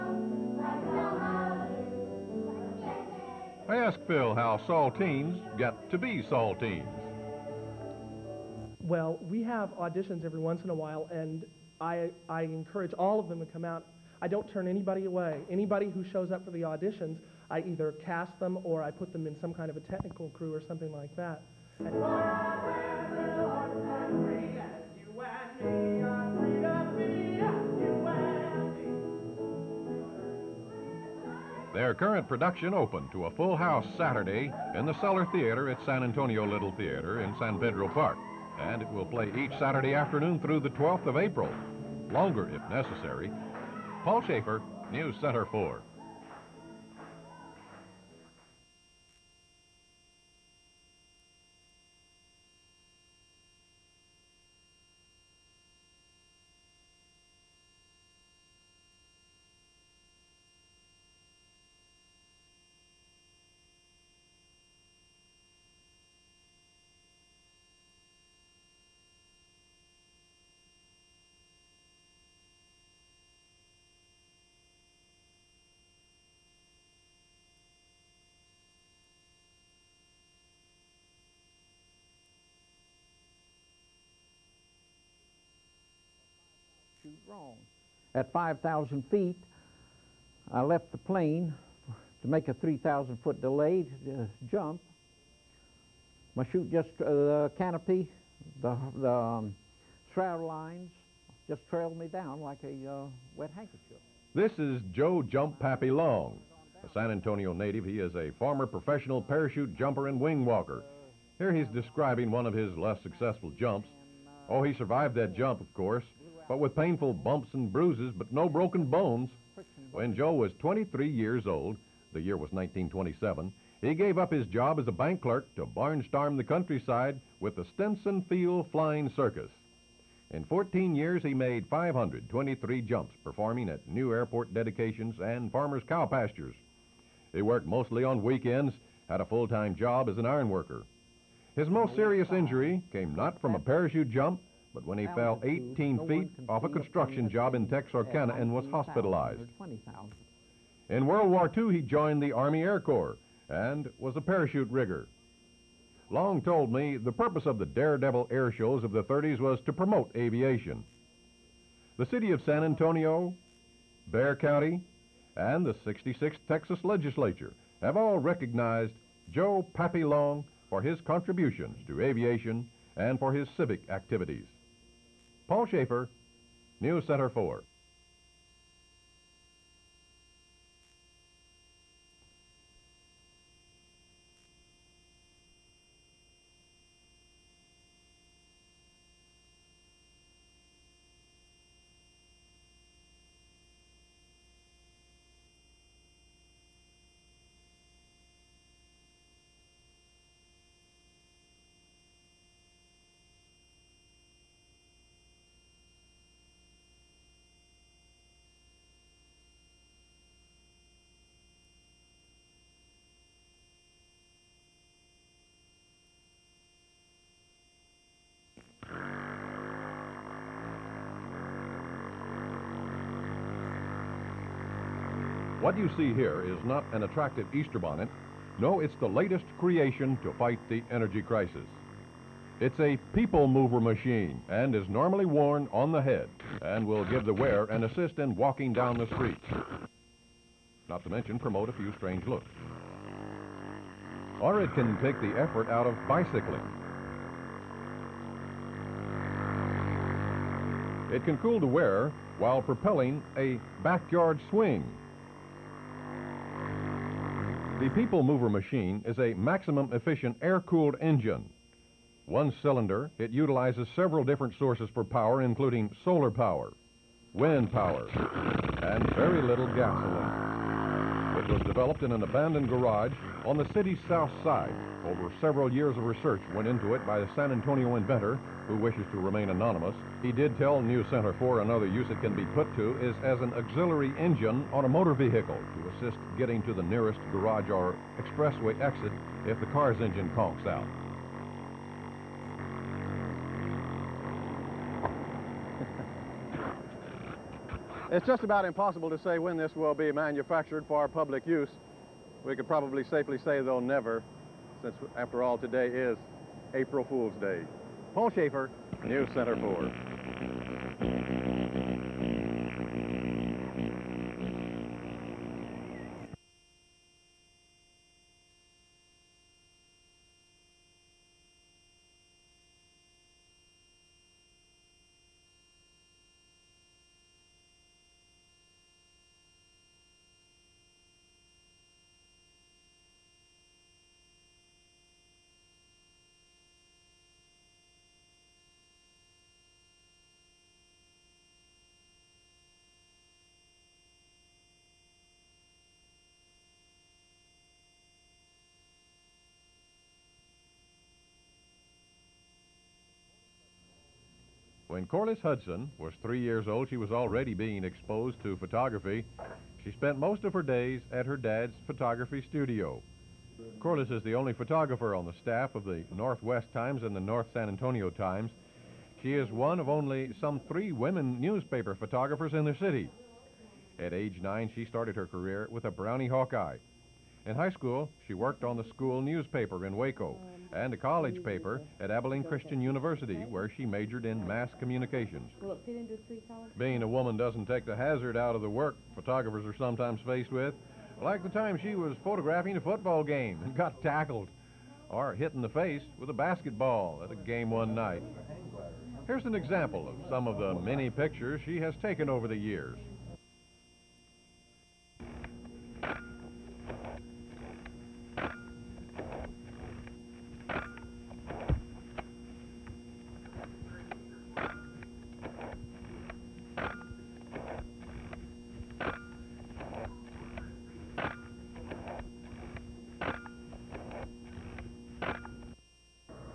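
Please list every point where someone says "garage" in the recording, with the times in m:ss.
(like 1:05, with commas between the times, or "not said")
4:32, 4:47.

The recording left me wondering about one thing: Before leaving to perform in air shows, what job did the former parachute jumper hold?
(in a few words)
bank clerk.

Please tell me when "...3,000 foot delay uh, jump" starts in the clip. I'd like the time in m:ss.
1:32.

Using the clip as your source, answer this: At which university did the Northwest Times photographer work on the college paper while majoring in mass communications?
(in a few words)
Abilene Christian University.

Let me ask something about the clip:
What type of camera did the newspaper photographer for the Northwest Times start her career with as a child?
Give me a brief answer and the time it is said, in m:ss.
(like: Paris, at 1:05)
Brownie Hawkeye, at 6:15.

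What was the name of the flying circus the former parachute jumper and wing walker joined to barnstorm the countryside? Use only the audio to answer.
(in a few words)
Stinson Field Flying Circus.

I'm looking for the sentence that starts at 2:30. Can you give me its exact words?
In World War II, he joined the Army Air Corps and was a parachute rigger.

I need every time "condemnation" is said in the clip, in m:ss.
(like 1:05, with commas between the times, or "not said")
not said.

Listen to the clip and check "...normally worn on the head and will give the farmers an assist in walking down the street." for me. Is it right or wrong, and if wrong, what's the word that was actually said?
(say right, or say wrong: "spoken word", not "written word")
wrong: "wearer", not "farmers".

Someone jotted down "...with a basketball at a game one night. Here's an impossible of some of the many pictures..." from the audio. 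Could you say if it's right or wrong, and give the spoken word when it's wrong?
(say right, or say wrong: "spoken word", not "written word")
wrong: "example", not "impossible".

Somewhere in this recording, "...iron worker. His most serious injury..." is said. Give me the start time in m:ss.
2:20.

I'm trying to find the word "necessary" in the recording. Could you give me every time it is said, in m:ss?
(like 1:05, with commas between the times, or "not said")
0:42.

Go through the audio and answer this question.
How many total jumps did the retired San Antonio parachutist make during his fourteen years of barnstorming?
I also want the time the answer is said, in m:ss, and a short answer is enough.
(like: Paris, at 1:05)
523, at 2:11.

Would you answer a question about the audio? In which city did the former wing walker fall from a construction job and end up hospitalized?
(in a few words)
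Texarkana.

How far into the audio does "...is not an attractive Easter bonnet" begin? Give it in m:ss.
3:46.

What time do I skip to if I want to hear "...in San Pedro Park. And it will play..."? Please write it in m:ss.
0:37.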